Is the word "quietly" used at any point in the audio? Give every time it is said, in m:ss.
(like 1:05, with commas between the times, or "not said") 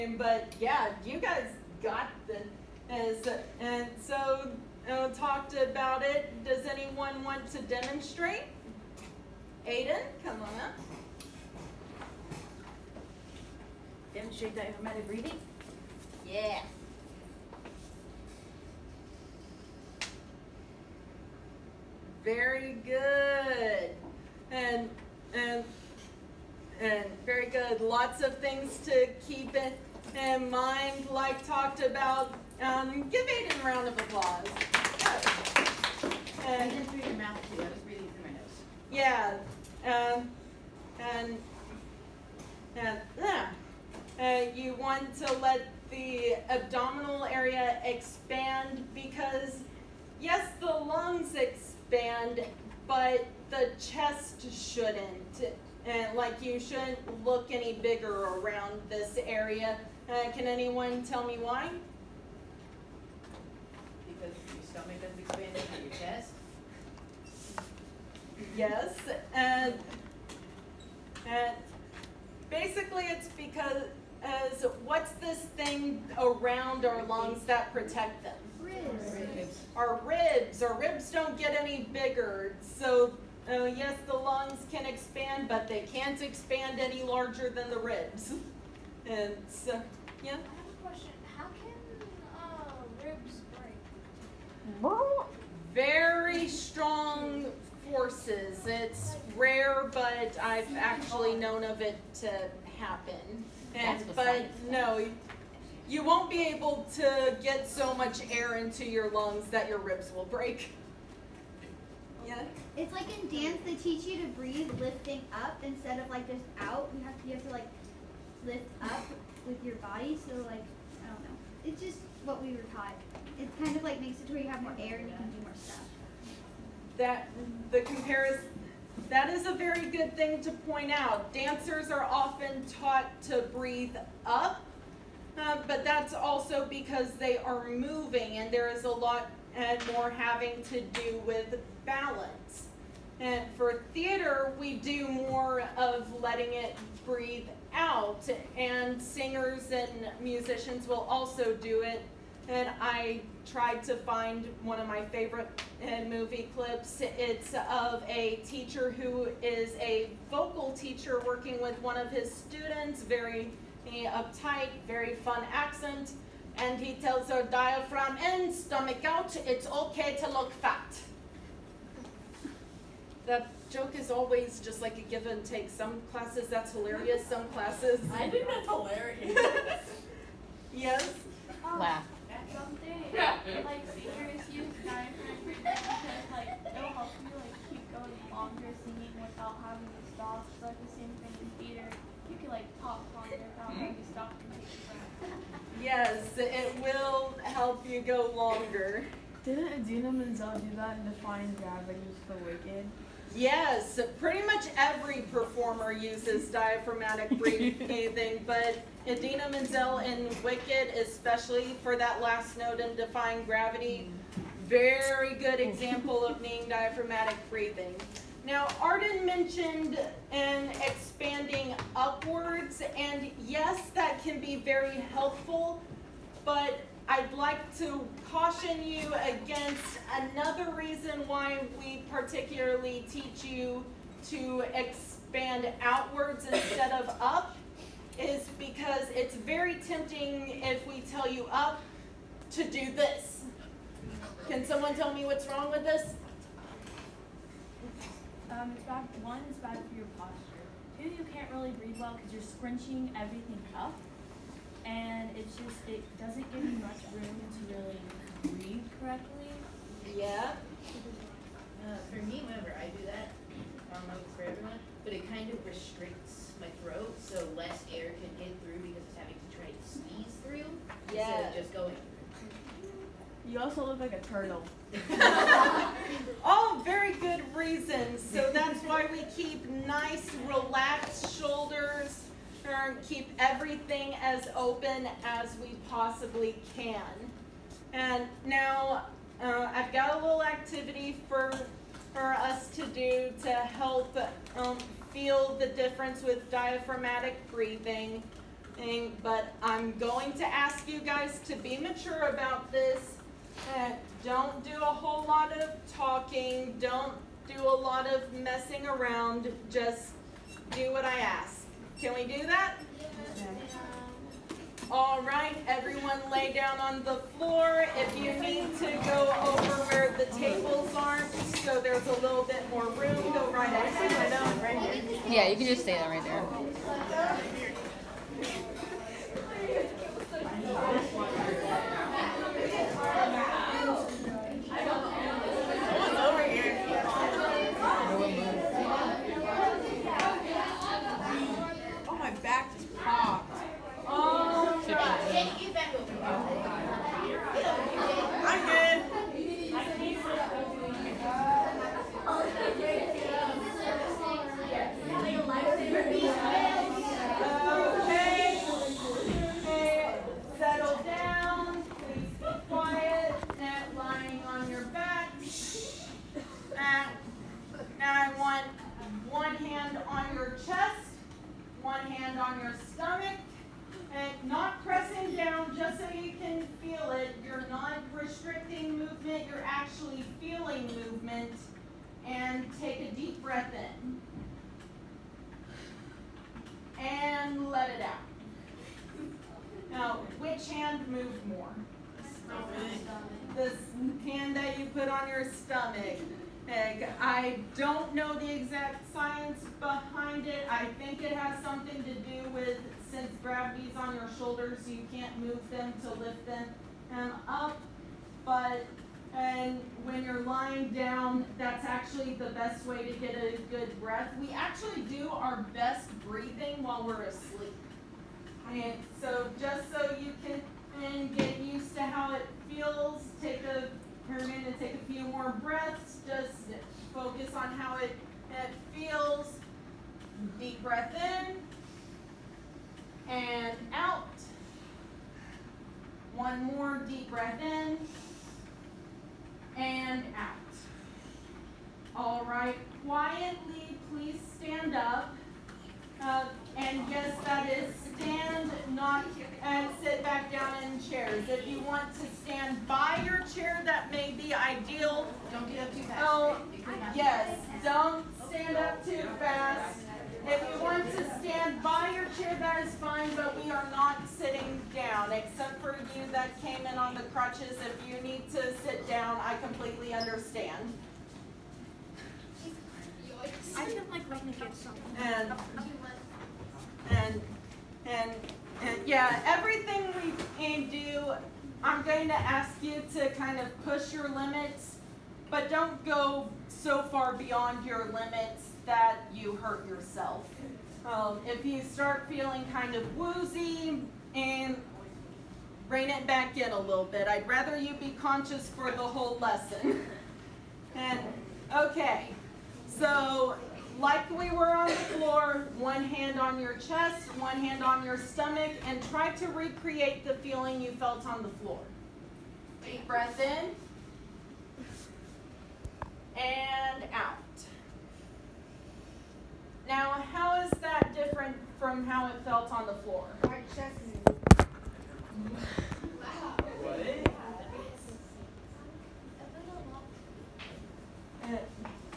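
7:23.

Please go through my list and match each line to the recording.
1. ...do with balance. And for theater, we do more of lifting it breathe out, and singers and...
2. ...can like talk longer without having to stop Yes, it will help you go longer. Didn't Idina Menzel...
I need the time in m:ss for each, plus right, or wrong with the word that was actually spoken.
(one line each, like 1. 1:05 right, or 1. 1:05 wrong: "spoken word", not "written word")
1. 2:20 wrong: "letting", not "lifting"
2. 3:12 right.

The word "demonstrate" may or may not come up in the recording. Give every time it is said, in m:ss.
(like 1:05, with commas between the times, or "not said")
0:07, 0:14.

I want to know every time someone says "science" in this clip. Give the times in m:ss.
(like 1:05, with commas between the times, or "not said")
6:39.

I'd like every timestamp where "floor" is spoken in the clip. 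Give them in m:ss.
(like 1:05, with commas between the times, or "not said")
5:17, 8:24, 8:31, 8:43.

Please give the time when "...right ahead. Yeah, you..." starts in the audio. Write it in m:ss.
5:23.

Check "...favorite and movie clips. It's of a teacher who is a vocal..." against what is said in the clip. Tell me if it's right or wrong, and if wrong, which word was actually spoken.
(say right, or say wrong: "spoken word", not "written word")
right.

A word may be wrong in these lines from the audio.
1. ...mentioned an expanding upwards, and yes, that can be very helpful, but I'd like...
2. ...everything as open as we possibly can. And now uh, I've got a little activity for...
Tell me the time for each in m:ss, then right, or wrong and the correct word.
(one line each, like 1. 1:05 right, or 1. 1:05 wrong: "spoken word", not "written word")
1. 3:39 right
2. 4:43 right.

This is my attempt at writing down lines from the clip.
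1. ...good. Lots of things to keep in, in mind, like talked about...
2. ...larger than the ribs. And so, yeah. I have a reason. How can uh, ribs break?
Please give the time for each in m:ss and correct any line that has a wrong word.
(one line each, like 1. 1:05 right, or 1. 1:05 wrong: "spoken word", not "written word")
1. 0:27 right
2. 1:27 wrong: "question", not "reason".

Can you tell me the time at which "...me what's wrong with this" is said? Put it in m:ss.
4:05.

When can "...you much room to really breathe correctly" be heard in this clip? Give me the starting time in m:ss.
4:16.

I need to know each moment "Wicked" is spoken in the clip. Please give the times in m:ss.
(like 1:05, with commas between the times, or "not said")
3:22, 3:30.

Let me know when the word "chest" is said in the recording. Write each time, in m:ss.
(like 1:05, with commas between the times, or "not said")
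0:53, 8:26.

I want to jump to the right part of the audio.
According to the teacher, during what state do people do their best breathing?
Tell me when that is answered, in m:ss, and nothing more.
6:57.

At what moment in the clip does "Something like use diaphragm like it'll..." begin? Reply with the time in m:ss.
3:02.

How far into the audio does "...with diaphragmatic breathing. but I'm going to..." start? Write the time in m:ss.
4:56.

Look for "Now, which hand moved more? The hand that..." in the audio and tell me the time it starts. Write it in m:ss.
6:29.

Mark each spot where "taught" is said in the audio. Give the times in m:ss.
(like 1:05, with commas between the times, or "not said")
2:02, 2:12.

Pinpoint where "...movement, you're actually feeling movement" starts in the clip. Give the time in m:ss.
6:18.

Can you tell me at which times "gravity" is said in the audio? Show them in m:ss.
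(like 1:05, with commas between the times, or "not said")
3:21, 3:33, 6:43.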